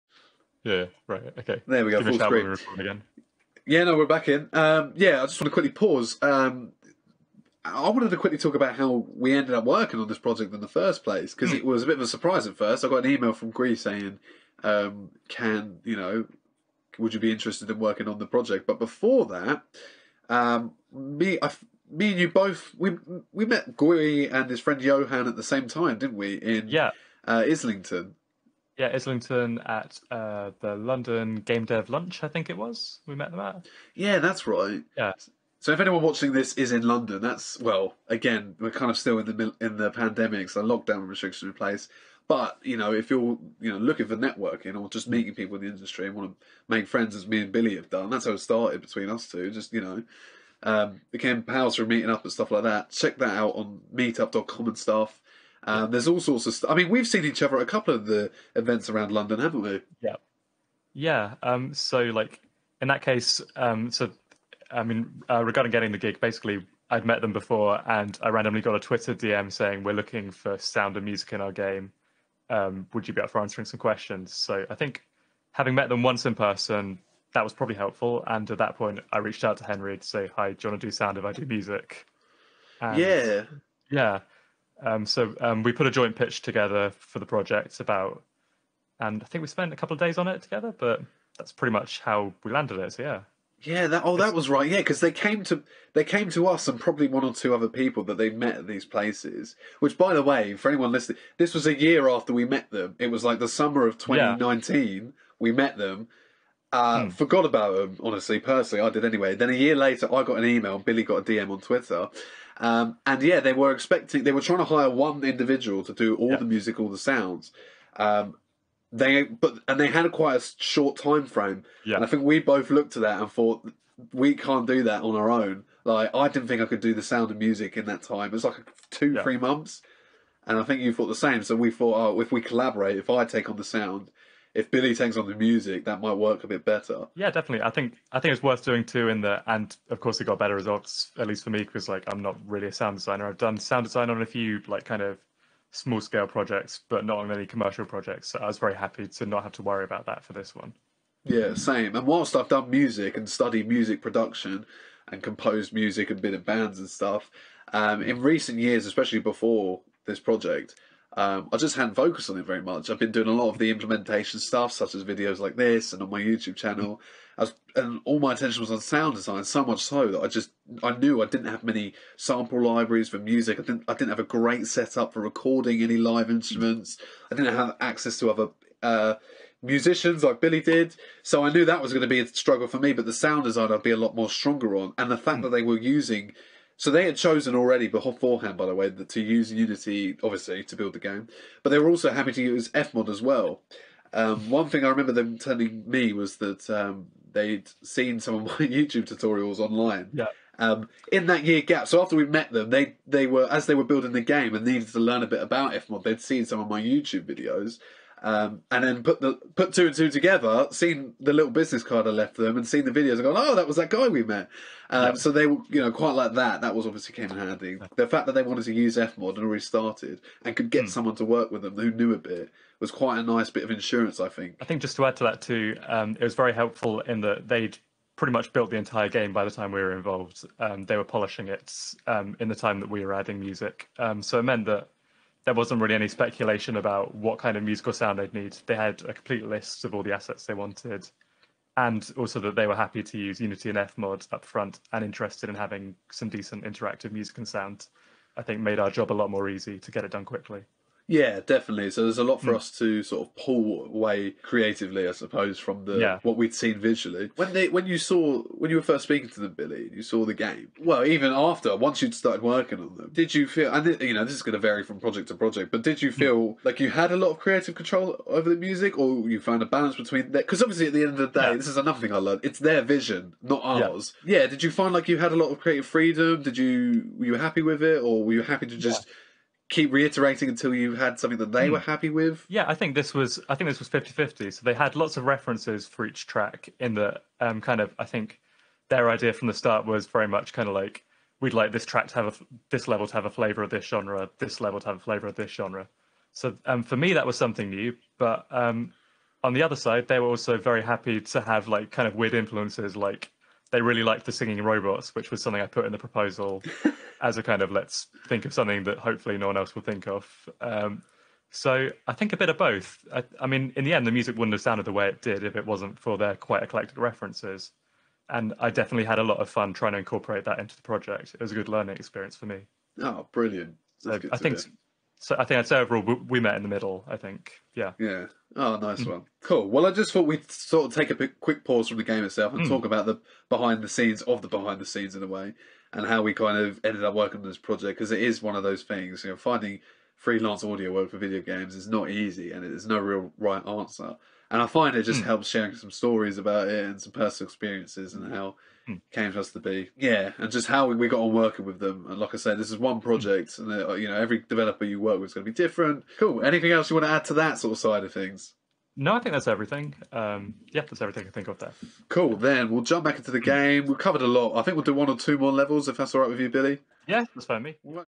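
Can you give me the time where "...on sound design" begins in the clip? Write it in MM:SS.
02:48.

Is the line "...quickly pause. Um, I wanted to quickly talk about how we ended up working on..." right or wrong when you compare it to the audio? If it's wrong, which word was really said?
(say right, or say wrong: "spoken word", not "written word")
right.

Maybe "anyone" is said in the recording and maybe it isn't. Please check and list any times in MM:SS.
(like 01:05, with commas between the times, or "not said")
00:35, 01:40.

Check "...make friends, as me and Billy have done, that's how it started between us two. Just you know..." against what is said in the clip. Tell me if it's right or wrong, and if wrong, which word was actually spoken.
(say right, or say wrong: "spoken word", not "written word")
right.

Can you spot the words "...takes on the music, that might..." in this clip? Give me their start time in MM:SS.
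02:14.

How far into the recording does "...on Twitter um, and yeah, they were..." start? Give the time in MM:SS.
01:51.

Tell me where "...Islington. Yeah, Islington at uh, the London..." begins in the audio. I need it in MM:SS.
00:27.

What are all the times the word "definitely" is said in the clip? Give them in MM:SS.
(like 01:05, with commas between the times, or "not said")
02:17, 04:11, 05:18.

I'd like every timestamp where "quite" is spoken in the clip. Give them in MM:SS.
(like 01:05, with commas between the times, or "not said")
02:00, 03:35, 03:42, 05:16.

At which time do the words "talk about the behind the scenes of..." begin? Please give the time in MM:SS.
05:32.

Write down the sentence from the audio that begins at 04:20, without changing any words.
Well, even after once you'd started working on them, did you feel?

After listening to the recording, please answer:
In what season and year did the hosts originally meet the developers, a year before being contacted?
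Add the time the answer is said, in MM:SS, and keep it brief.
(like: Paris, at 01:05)
summer of 2019, at 01:43.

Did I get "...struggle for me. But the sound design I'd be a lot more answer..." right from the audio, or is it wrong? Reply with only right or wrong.
wrong.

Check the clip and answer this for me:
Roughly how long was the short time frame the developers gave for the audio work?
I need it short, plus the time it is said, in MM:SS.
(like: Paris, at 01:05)
3 months, at 02:09.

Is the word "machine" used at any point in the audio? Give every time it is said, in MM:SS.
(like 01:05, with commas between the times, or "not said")
not said.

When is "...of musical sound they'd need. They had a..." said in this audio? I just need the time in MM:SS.
03:57.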